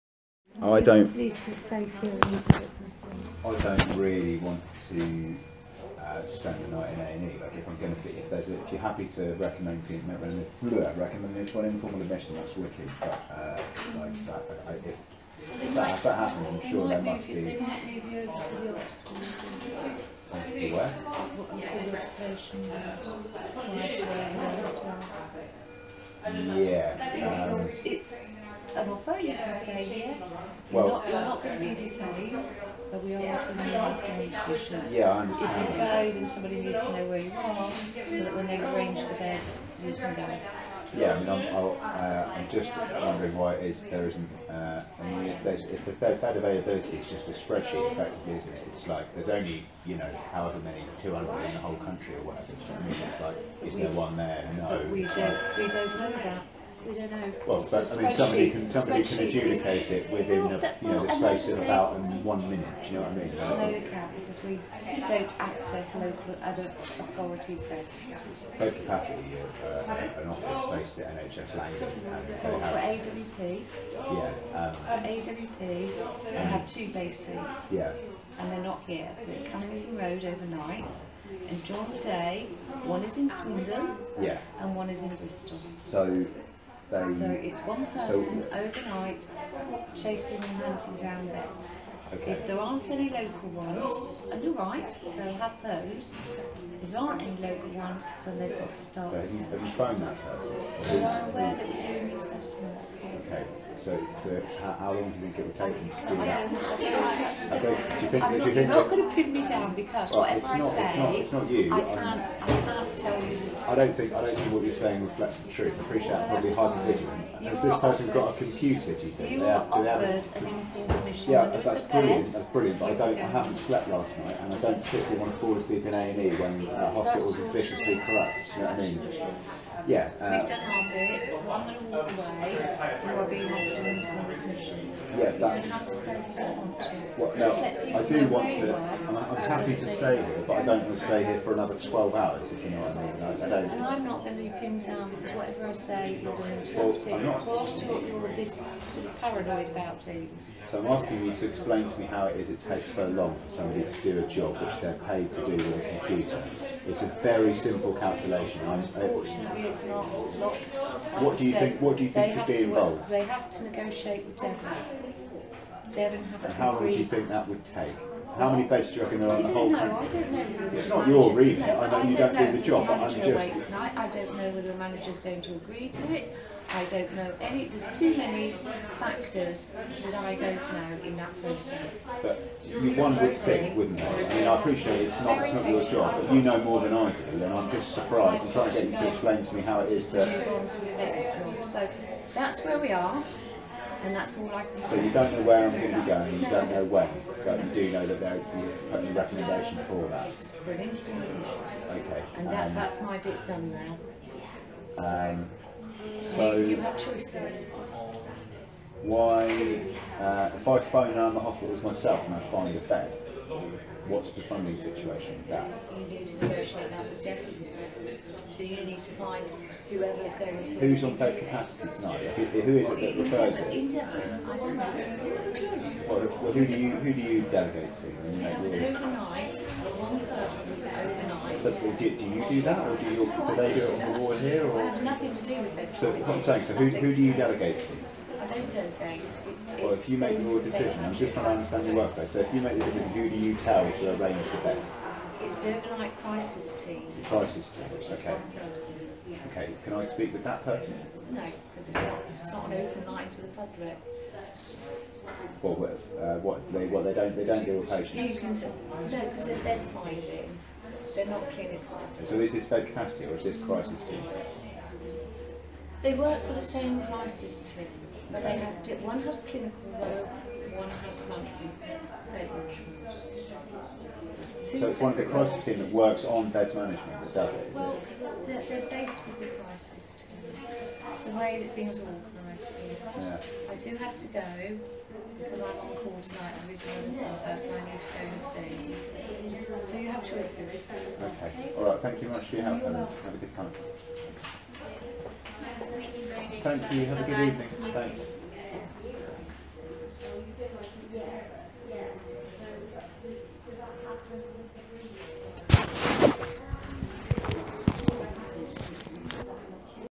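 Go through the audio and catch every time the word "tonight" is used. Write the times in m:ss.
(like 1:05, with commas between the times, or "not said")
2:53, 3:41, 4:46.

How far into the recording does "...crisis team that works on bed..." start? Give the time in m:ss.
4:35.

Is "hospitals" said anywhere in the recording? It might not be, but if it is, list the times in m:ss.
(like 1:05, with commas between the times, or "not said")
2:06, 3:31.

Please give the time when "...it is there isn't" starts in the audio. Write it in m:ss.
0:43.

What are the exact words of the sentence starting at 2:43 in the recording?
They have to negotiate with Devon.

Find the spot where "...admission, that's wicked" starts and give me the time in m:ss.
0:12.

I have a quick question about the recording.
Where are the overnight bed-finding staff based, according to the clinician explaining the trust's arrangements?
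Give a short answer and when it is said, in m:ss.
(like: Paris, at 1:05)
Callington Road, at 1:19.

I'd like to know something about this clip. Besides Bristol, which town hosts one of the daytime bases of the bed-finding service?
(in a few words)
Swindon.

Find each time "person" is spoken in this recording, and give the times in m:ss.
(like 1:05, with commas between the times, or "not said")
1:27, 1:40, 1:57, 3:50, 4:10, 4:47.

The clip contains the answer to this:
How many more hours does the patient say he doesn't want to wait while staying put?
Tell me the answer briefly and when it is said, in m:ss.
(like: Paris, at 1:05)
12, at 2:21.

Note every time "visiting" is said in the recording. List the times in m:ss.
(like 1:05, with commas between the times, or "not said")
4:46.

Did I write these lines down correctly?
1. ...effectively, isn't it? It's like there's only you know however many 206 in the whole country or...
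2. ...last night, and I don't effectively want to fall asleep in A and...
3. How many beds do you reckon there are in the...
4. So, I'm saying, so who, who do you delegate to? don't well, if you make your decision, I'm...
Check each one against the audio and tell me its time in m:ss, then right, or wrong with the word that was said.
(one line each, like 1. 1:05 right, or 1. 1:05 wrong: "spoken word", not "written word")
1. 0:47 wrong: "200", not "206"
2. 2:03 wrong: "particularly", not "effectively"
3. 2:48 right
4. 3:55 right.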